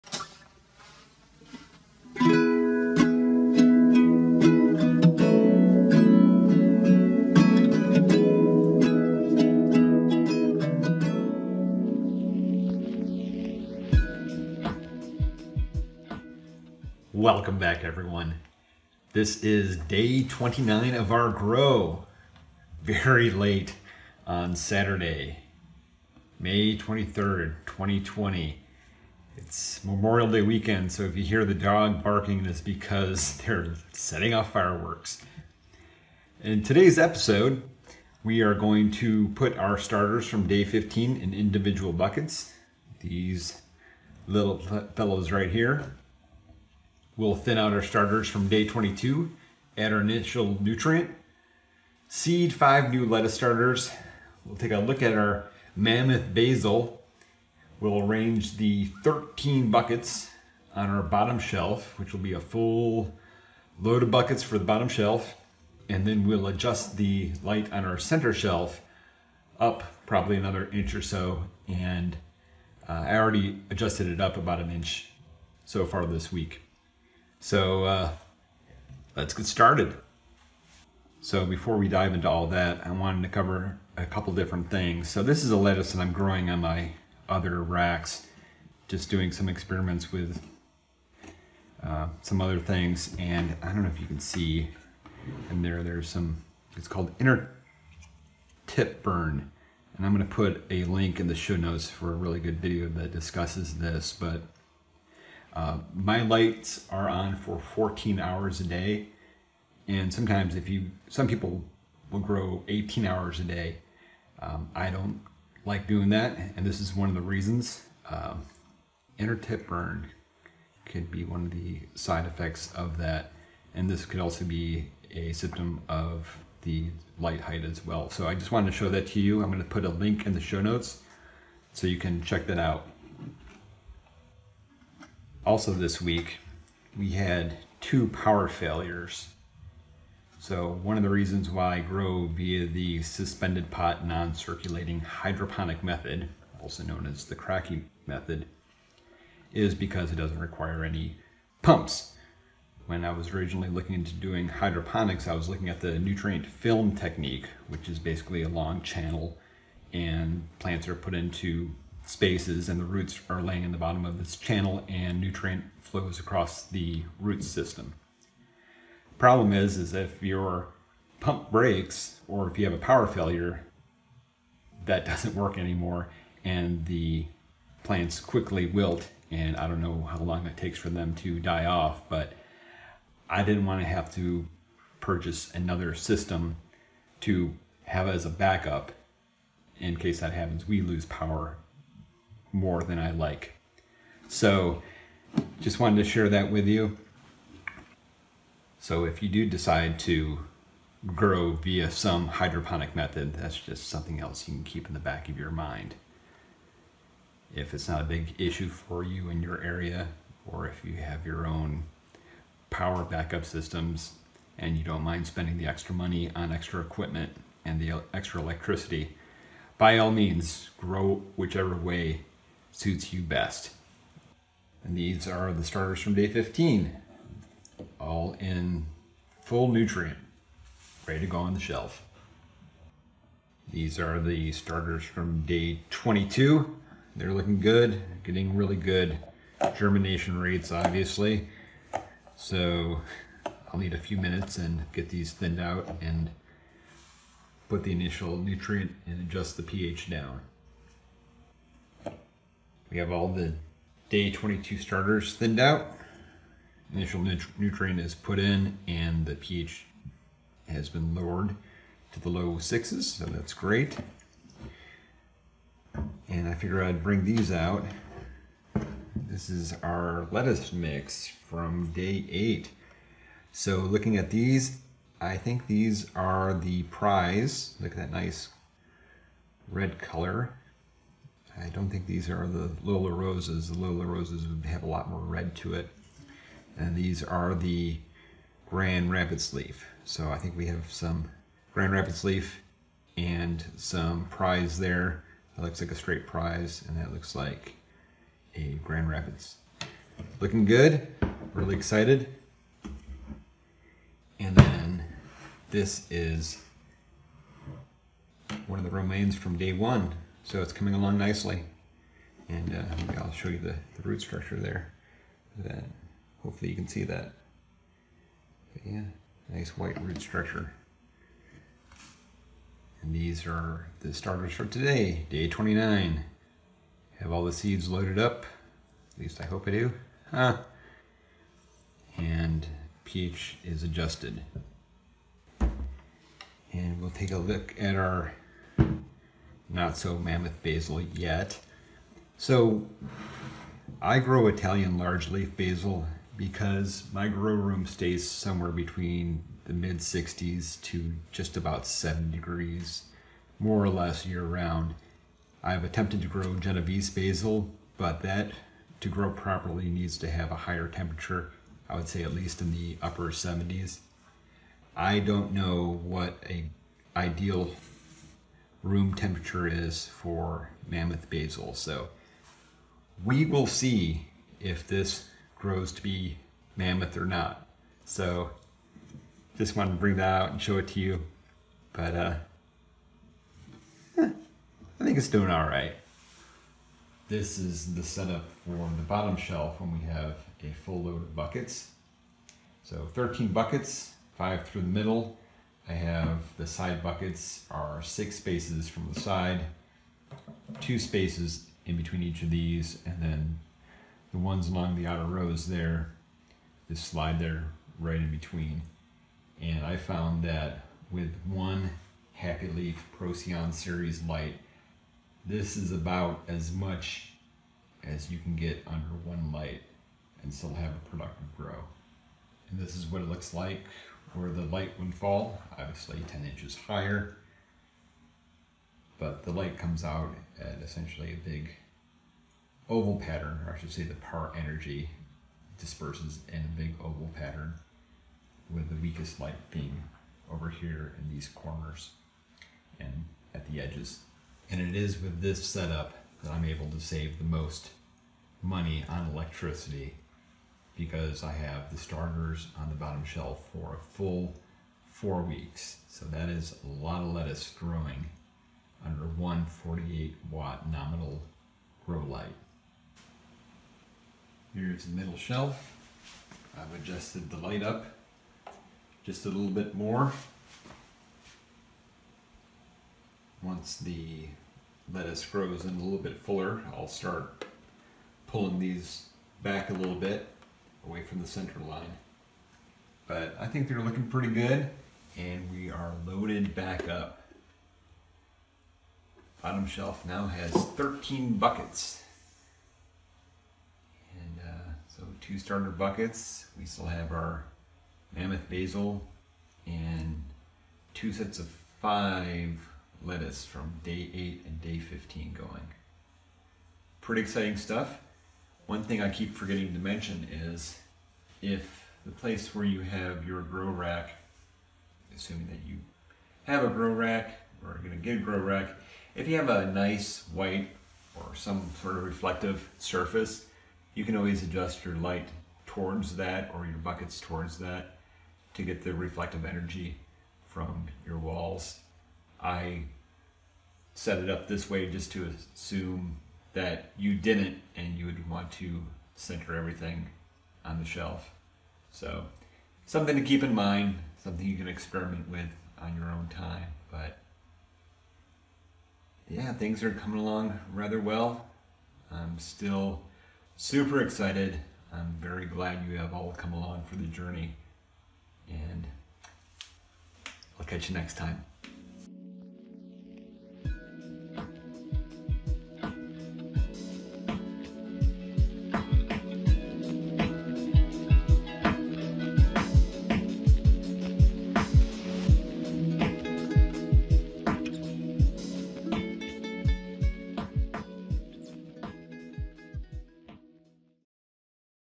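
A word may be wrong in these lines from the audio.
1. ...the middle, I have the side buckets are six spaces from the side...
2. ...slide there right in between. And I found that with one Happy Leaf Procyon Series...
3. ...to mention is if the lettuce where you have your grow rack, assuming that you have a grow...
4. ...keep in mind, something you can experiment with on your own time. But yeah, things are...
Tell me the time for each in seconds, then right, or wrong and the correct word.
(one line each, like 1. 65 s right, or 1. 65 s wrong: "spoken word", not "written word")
1. 394 s right
2. 407 s right
3. 509 s wrong: "place", not "lettuce"
4. 543 s right.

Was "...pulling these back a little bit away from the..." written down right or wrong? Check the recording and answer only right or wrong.
right.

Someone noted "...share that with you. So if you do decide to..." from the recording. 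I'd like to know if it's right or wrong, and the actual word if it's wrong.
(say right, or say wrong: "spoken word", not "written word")
right.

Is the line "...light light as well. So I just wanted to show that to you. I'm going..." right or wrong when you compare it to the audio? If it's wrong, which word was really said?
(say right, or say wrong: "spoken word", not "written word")
wrong: "height", not "light".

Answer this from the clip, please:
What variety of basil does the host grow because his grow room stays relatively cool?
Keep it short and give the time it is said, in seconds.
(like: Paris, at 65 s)
Italian large leaf, at 344 s.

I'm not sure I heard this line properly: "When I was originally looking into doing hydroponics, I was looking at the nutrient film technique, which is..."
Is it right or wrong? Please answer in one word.
right.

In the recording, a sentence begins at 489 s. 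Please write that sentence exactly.
Bottom shelf now has 13 buckets.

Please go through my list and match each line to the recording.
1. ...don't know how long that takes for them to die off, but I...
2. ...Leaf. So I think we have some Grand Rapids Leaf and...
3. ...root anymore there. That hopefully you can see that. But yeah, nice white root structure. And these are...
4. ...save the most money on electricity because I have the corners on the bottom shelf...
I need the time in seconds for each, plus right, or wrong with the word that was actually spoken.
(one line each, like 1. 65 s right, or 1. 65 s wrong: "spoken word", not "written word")
1. 179 s right
2. 289 s right
3. 314 s wrong: "structure", not "anymore"
4. 446 s wrong: "starters", not "corners".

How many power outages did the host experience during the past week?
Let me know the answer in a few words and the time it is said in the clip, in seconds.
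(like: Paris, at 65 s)
2, at 137 s.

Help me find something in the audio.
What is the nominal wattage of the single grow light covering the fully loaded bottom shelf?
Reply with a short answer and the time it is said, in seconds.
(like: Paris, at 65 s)
48 watts, at 459 s.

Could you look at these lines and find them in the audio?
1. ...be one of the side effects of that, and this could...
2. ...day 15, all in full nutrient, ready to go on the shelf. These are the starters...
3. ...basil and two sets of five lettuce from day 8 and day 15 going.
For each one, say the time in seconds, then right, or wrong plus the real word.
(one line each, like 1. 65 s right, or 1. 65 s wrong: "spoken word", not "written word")
1. 121 s right
2. 226 s right
3. 498 s right.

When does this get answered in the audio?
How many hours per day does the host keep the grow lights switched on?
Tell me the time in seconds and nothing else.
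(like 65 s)
107 s.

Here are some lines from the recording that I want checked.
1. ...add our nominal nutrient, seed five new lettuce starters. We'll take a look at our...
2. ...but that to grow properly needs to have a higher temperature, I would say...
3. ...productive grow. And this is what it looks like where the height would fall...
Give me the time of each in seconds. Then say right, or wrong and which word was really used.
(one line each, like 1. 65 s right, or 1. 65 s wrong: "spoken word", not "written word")
1. 49 s wrong: "initial", not "nominal"
2. 357 s right
3. 421 s wrong: "light", not "height".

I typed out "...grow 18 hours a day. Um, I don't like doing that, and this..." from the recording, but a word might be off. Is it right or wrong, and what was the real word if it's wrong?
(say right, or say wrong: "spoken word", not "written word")
right.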